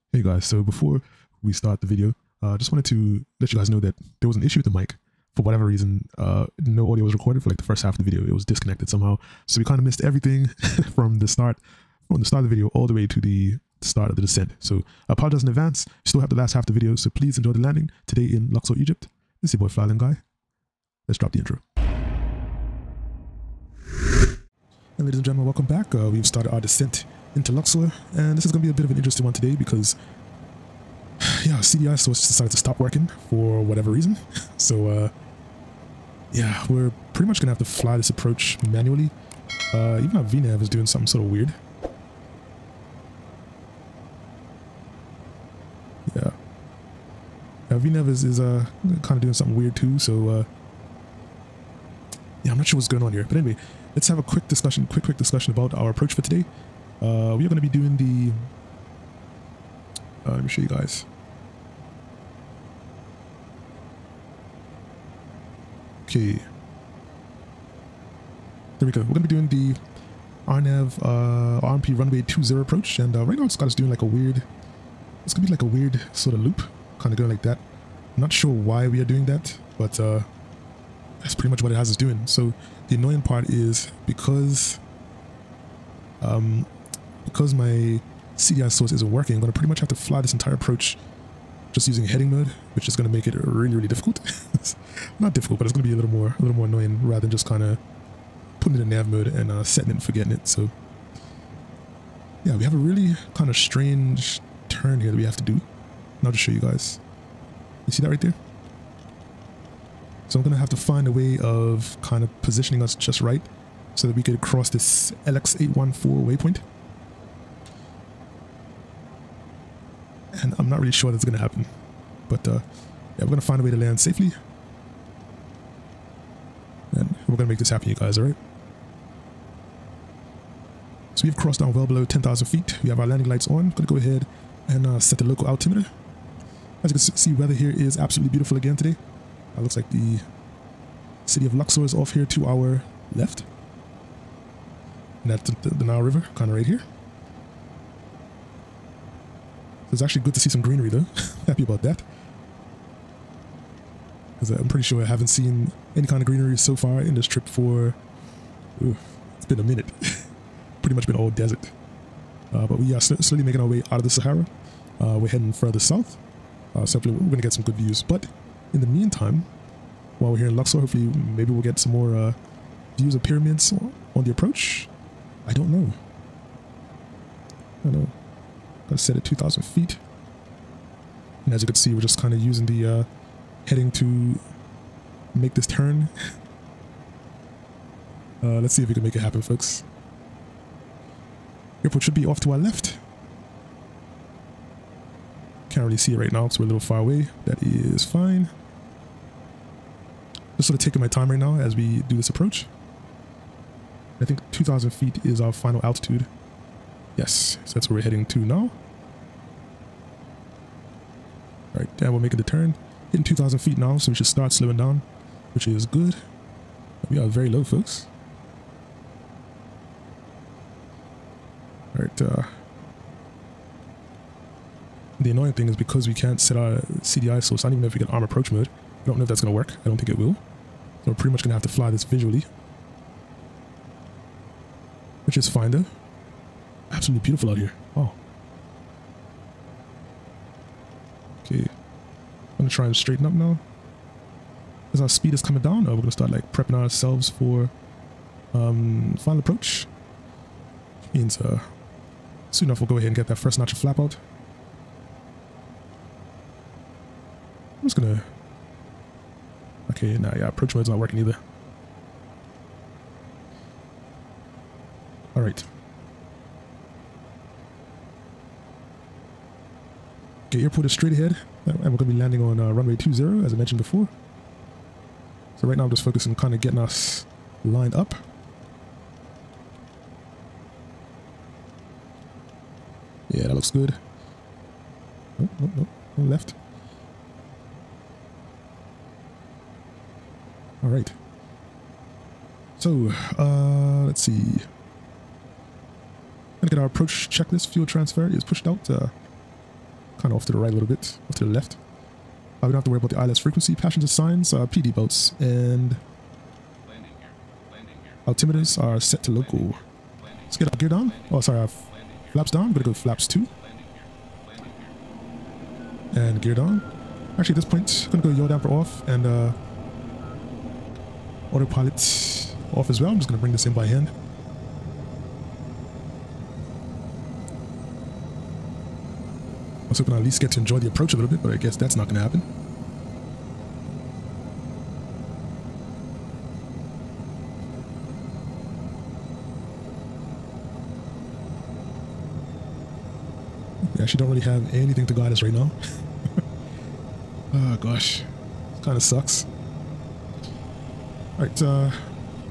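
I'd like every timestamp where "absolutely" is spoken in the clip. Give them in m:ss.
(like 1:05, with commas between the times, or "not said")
2:17, 3:56.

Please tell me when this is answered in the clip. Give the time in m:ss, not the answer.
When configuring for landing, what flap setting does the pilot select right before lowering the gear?
5:12.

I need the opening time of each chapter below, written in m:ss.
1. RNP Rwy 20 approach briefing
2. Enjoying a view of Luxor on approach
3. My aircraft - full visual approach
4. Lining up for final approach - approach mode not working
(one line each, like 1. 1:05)
1. 1:06
2. 2:18
3. 5:19
4. 4:09.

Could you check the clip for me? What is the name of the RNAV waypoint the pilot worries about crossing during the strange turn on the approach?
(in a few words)
LX814.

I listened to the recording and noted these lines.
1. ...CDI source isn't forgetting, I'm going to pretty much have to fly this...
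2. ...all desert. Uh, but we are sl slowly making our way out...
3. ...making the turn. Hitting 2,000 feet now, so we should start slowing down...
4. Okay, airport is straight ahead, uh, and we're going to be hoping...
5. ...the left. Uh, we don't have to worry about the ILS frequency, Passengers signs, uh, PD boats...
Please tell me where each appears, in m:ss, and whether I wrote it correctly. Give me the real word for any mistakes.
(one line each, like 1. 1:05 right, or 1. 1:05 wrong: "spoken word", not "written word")
1. 1:28 wrong: "working", not "forgetting"
2. 2:41 right
3. 3:32 right
4. 4:30 wrong: "landing", not "hoping"
5. 5:01 right.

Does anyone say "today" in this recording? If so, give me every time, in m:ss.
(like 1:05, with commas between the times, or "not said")
0:18, 0:29, 0:56, 2:18.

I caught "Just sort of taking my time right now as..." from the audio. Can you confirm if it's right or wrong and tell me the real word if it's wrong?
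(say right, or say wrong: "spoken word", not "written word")
right.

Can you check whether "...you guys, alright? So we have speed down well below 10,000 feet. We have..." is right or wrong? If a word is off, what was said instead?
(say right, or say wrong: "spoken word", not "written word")
wrong: "crossed", not "speed".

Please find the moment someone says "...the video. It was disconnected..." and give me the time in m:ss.
0:07.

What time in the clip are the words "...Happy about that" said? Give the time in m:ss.
2:31.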